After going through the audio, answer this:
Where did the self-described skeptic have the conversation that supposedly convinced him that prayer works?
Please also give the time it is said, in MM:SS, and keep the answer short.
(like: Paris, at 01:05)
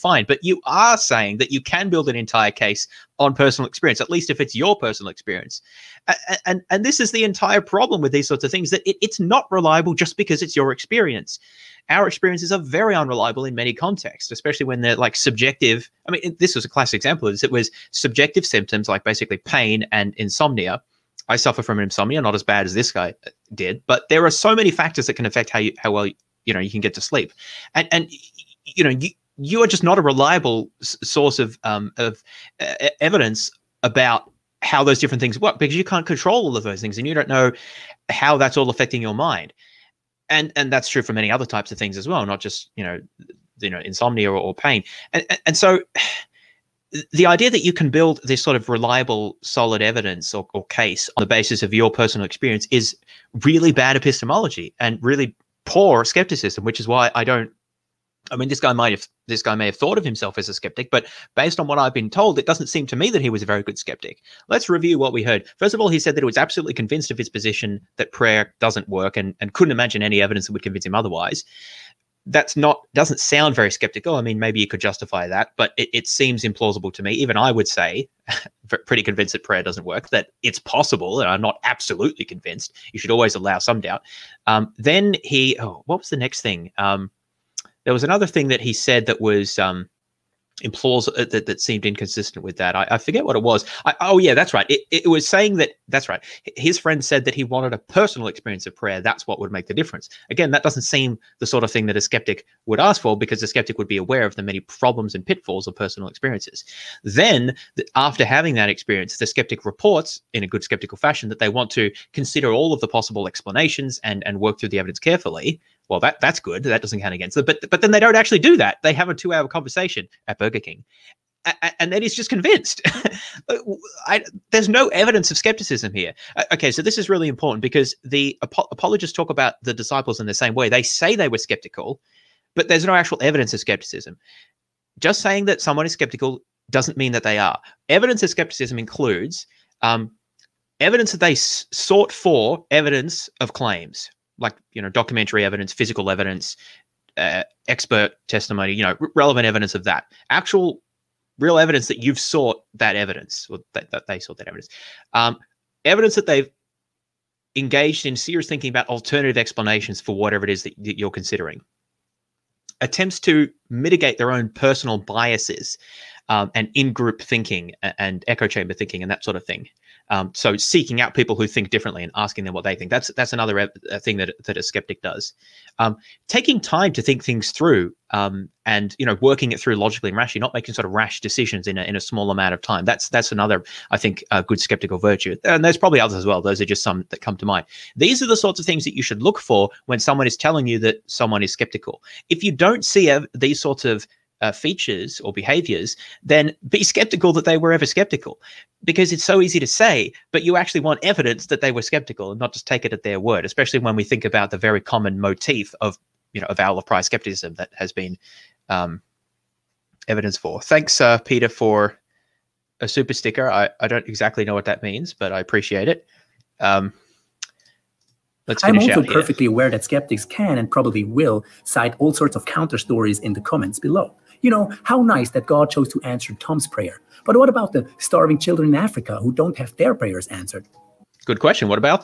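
Burger King, at 02:00.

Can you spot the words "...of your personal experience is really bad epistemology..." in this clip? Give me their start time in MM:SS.
00:51.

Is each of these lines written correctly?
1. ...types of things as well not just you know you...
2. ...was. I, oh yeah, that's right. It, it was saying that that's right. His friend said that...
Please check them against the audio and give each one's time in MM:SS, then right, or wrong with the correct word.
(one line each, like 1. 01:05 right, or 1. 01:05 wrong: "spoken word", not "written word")
1. 00:41 right
2. 01:33 right.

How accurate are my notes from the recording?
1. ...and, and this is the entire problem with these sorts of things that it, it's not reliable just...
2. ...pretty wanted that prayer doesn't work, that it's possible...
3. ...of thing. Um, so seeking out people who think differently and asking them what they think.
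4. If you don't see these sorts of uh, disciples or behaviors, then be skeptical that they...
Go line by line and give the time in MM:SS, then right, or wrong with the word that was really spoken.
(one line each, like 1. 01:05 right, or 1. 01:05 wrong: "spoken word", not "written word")
1. 00:06 right
2. 01:18 wrong: "convinced", not "wanted"
3. 02:49 right
4. 03:12 wrong: "features", not "disciples".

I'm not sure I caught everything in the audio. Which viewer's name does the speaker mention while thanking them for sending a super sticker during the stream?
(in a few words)
Peter.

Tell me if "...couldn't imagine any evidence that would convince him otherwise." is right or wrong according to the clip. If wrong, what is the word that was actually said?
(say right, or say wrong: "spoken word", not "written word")
right.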